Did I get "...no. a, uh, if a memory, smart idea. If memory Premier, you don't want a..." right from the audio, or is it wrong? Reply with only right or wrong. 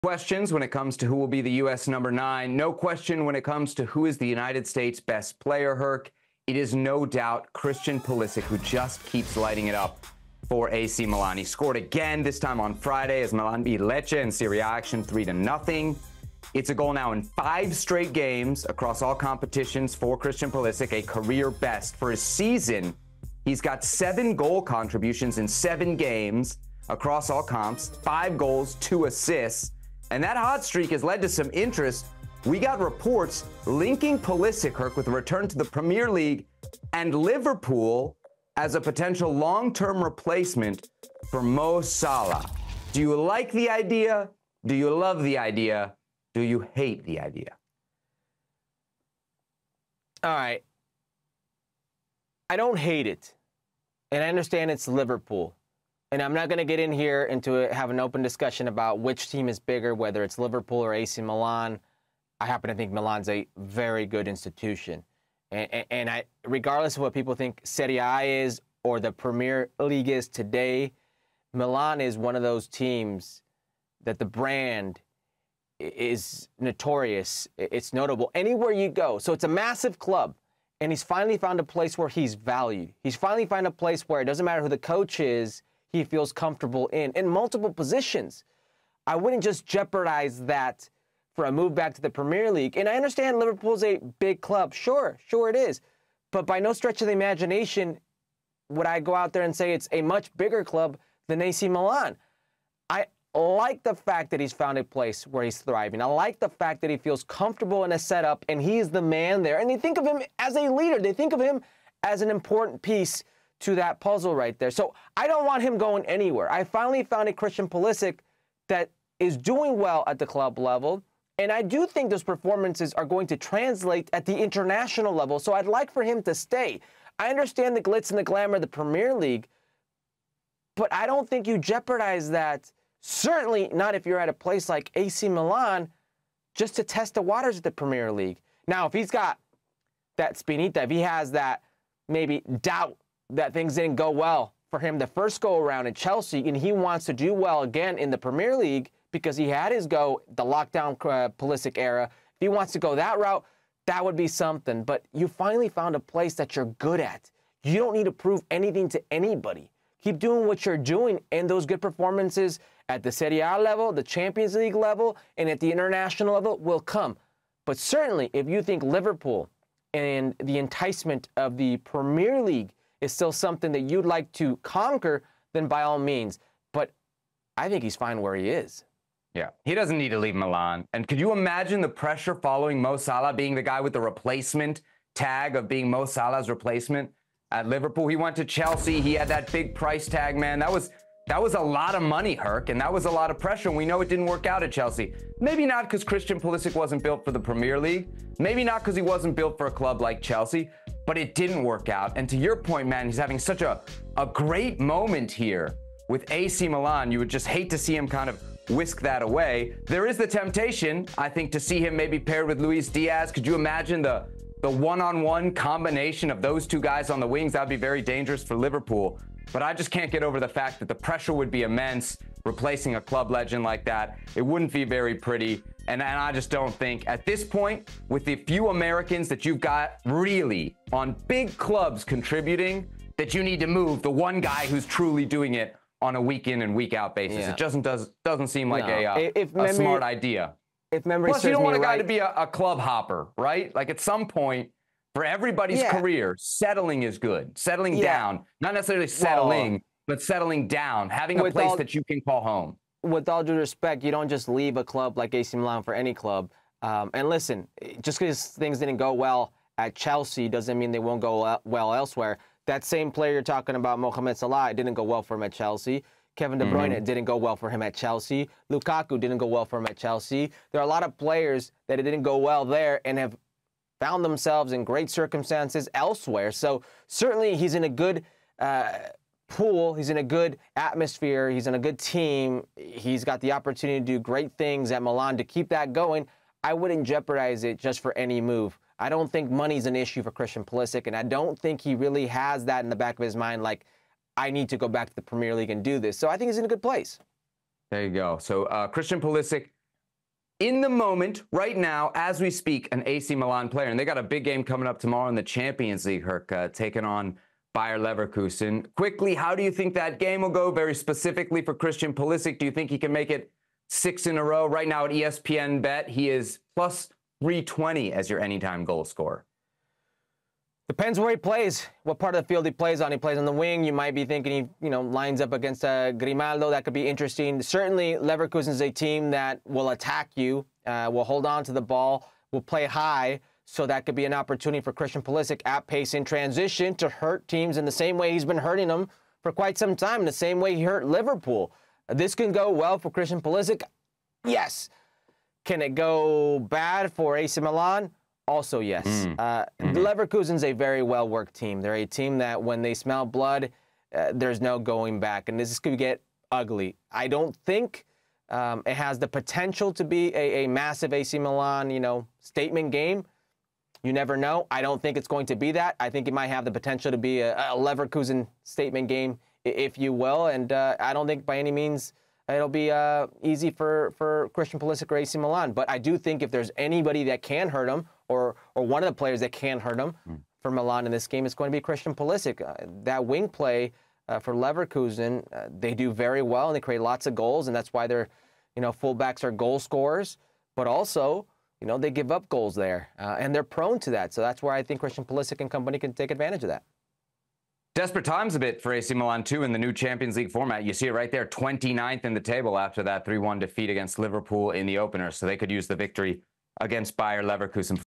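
wrong.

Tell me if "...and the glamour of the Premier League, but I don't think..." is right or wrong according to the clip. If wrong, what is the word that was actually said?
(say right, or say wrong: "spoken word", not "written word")
right.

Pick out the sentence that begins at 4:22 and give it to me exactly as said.
That same player you're talking about, Mohamed Salah, it didn't go well for him at Chelsea.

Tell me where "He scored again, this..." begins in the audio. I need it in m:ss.
0:11.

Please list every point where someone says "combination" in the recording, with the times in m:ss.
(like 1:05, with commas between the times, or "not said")
3:35.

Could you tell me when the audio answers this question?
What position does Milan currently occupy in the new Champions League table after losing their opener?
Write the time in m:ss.
6:41.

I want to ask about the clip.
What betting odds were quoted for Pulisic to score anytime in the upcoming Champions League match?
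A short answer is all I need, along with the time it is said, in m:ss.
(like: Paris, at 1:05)
+320, at 5:16.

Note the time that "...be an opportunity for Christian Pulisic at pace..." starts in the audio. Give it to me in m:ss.
5:34.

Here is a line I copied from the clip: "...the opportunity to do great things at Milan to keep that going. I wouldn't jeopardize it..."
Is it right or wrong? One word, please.
right.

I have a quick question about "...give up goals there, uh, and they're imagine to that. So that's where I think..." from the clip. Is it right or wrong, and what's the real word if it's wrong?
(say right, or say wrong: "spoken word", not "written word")
wrong: "prone", not "imagine".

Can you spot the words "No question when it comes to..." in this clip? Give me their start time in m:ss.
0:02.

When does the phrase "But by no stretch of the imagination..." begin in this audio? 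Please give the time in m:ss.
1:36.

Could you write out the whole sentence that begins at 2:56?
But I think he's fine where he is.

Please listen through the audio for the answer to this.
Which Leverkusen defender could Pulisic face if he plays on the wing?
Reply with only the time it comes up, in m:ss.
5:26.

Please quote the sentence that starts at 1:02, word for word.
I happen to think Milan's a very good institution.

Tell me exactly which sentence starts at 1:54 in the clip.
So I don't want him going anywhere.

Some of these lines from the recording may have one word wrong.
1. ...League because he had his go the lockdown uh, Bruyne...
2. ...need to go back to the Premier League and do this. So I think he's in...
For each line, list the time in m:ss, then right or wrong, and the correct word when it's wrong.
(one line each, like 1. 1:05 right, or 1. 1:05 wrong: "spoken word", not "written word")
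1. 2:28 wrong: "Pulisic", not "Bruyne"
2. 4:54 right.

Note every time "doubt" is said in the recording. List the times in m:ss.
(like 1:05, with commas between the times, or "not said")
0:07, 2:22.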